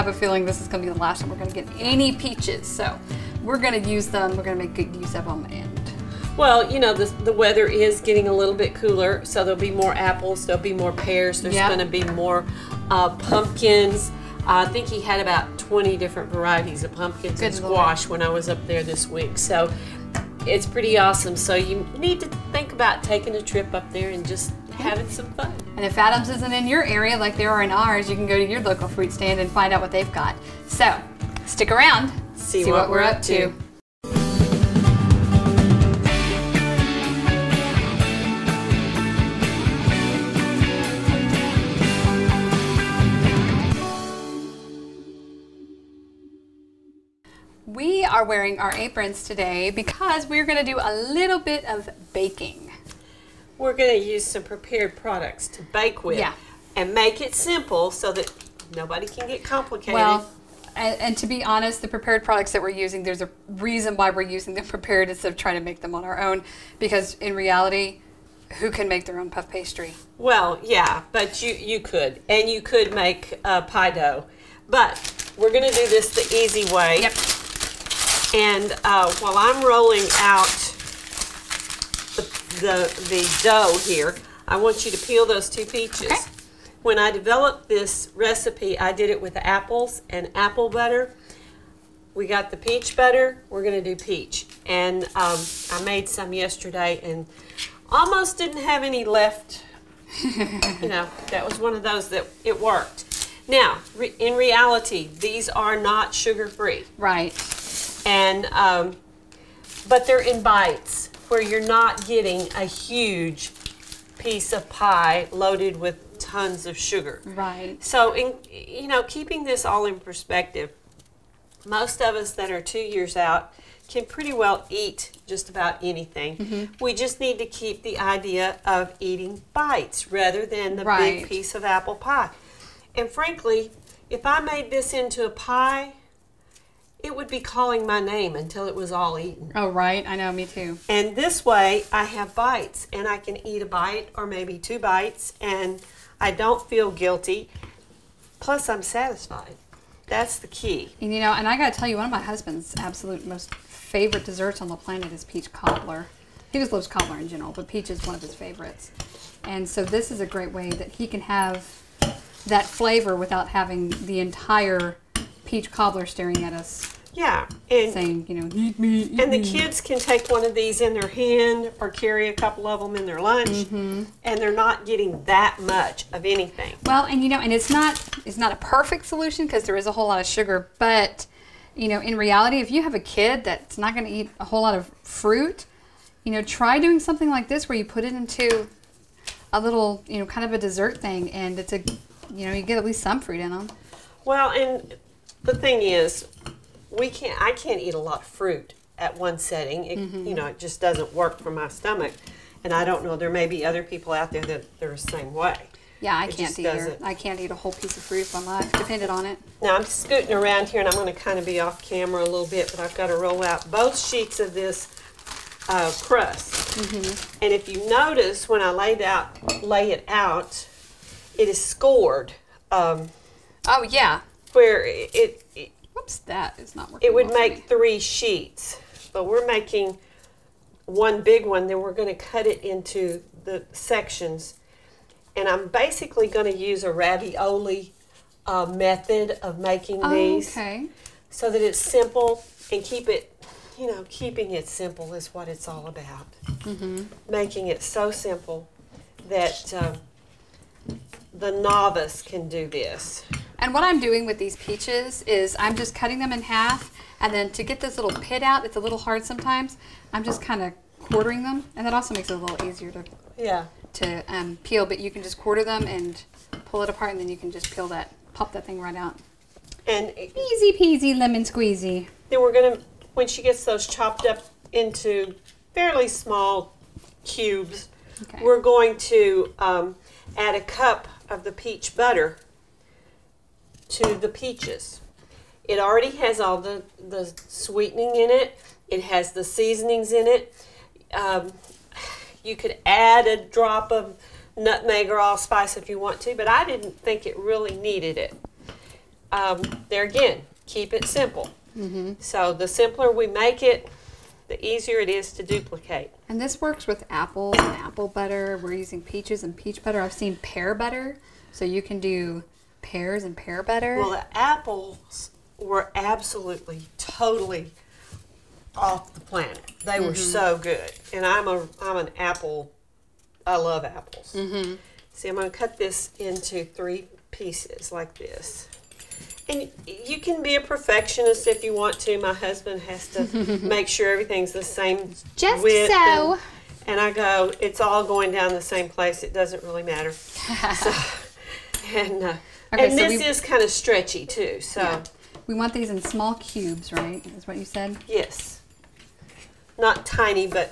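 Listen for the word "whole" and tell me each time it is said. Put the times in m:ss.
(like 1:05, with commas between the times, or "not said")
2:59, 3:04, 3:27.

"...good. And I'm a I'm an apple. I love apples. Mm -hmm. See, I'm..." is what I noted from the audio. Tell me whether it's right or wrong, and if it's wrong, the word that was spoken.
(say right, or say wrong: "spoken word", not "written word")
right.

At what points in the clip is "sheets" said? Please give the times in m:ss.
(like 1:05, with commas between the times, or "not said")
3:33, 3:47.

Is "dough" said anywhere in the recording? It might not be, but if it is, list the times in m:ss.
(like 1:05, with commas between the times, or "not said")
1:13, 1:23.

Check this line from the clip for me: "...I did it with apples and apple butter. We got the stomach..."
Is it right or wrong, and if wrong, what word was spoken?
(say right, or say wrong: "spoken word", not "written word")
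wrong: "peach", not "stomach".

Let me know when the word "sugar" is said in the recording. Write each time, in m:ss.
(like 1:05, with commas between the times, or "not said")
1:46, 1:56, 3:00.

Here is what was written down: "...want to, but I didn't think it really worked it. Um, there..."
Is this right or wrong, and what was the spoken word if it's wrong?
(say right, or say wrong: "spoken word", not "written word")
wrong: "needed", not "worked".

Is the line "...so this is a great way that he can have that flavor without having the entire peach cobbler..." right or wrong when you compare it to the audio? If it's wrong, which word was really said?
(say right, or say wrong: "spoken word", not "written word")
right.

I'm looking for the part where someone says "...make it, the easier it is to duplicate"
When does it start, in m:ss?
5:03.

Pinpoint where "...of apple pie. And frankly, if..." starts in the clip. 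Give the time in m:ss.
2:11.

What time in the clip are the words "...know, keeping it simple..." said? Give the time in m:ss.
4:03.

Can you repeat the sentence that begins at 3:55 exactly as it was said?
And I'm basically going to use a ravioli uh, method of making oh, these.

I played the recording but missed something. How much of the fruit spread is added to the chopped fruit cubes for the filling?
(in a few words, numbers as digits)
1 cup.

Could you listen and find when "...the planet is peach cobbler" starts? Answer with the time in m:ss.
2:34.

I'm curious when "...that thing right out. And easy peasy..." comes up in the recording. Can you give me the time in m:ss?
4:28.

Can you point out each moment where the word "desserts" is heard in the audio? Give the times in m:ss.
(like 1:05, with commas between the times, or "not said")
2:34, 3:10.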